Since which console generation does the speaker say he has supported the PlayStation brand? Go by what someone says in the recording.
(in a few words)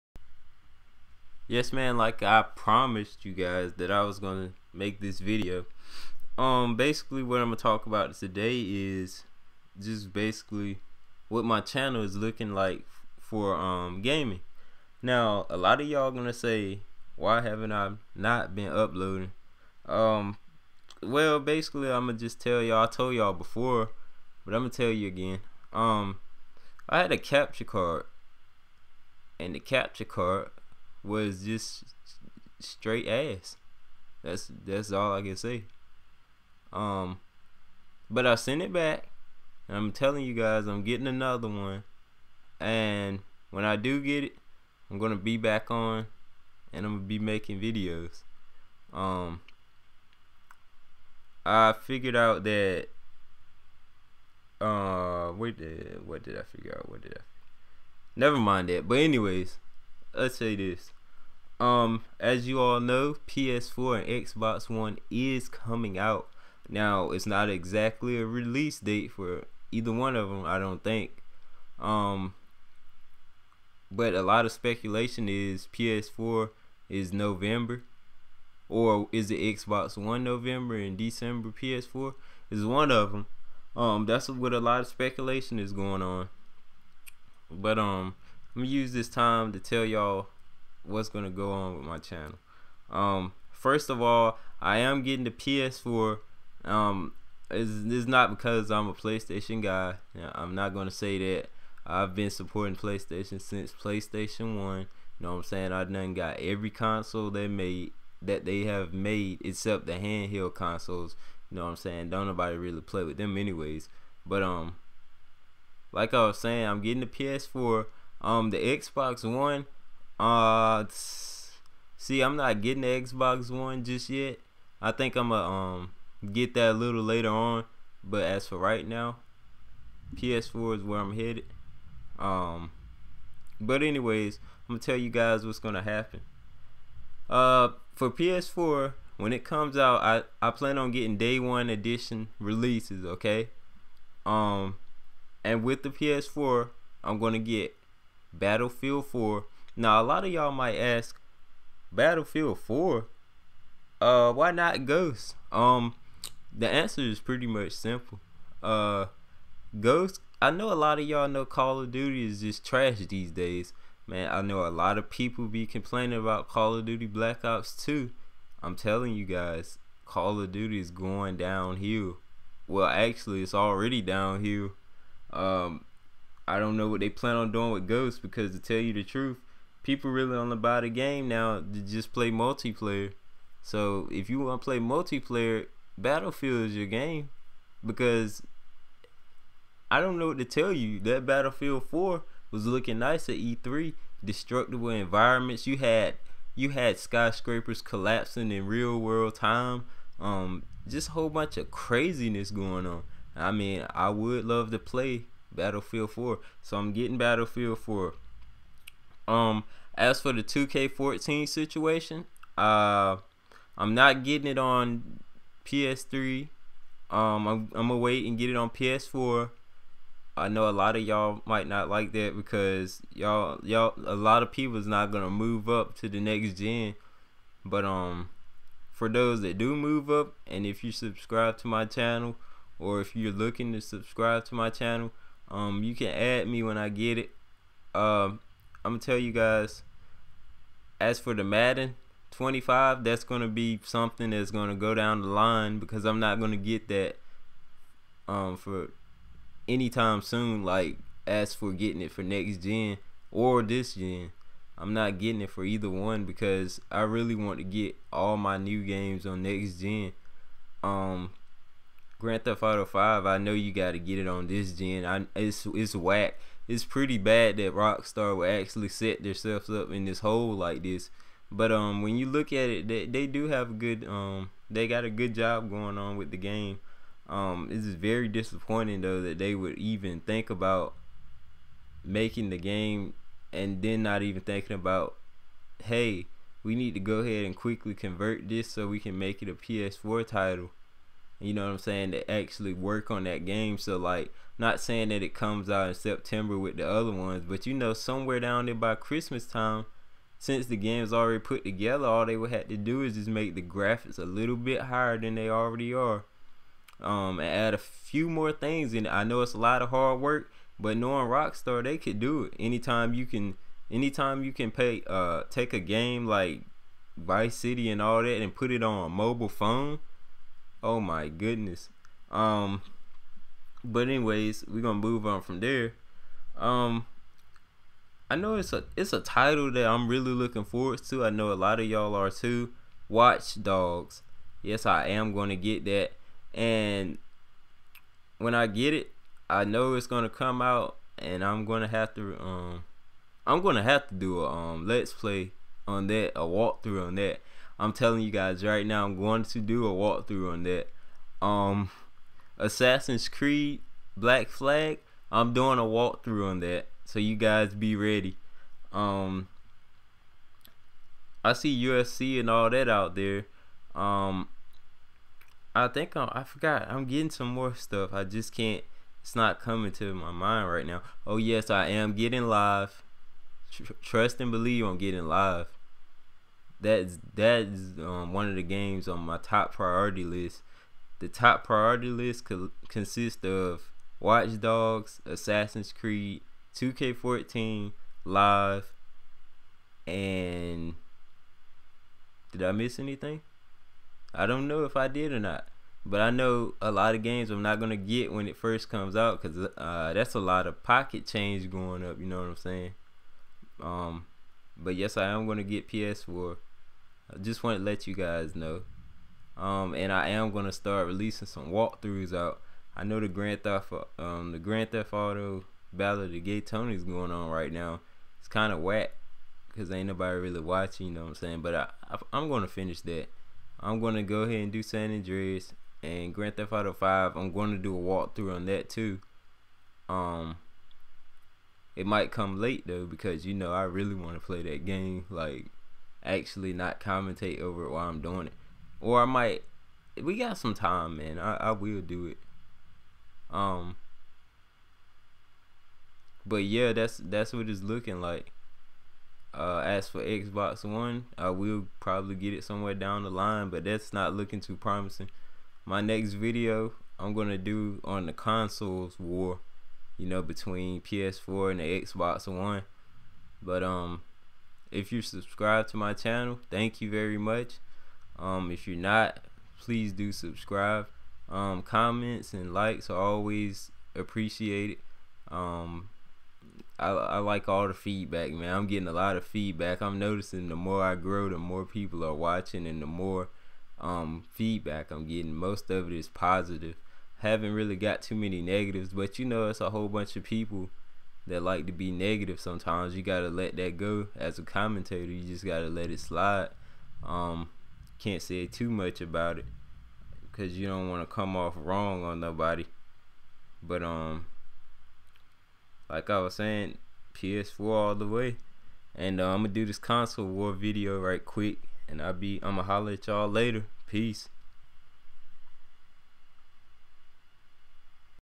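PlayStation One.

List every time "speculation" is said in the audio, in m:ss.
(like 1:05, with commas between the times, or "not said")
1:14, 1:24.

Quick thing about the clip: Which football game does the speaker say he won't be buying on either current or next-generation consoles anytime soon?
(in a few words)
Madden 25.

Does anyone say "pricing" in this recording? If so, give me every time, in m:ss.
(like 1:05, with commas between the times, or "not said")
not said.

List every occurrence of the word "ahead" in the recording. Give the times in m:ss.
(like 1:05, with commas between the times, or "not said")
4:47, 7:04.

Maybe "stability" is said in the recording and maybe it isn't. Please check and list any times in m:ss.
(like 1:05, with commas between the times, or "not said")
not said.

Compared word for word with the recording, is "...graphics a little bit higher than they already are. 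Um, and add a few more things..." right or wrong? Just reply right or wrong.
right.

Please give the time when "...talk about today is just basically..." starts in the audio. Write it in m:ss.
0:07.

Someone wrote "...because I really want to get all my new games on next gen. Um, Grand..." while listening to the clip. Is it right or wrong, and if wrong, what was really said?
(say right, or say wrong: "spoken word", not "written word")
right.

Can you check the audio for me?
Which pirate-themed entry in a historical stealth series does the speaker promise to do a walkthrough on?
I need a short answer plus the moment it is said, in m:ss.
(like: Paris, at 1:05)
Assassin's Creed Black Flag, at 5:52.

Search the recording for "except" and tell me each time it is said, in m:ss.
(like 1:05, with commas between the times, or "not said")
1:49.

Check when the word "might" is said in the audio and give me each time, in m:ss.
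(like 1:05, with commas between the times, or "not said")
2:30, 3:41, 7:12, 7:19.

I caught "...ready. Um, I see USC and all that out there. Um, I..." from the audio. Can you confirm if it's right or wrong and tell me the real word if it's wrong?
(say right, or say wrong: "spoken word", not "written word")
right.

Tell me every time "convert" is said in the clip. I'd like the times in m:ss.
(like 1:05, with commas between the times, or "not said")
4:47.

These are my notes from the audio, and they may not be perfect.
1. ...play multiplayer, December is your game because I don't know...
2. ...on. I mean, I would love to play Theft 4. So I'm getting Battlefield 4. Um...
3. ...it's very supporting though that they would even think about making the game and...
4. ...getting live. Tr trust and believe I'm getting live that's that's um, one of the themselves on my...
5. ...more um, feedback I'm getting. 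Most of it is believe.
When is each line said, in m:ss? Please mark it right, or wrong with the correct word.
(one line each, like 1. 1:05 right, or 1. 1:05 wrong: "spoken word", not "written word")
1. 3:04 wrong: "Battlefield", not "December"
2. 3:22 wrong: "Battlefield", not "Theft"
3. 4:37 wrong: "disappointing", not "supporting"
4. 6:12 wrong: "games", not "themselves"
5. 8:03 wrong: "positive", not "believe".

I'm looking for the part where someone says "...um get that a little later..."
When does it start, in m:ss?
2:05.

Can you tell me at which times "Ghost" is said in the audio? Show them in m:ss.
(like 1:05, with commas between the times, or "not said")
2:34, 2:39, 2:57.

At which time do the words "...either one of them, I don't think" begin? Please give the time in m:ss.
1:09.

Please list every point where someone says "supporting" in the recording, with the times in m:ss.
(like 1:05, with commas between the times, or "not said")
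1:42.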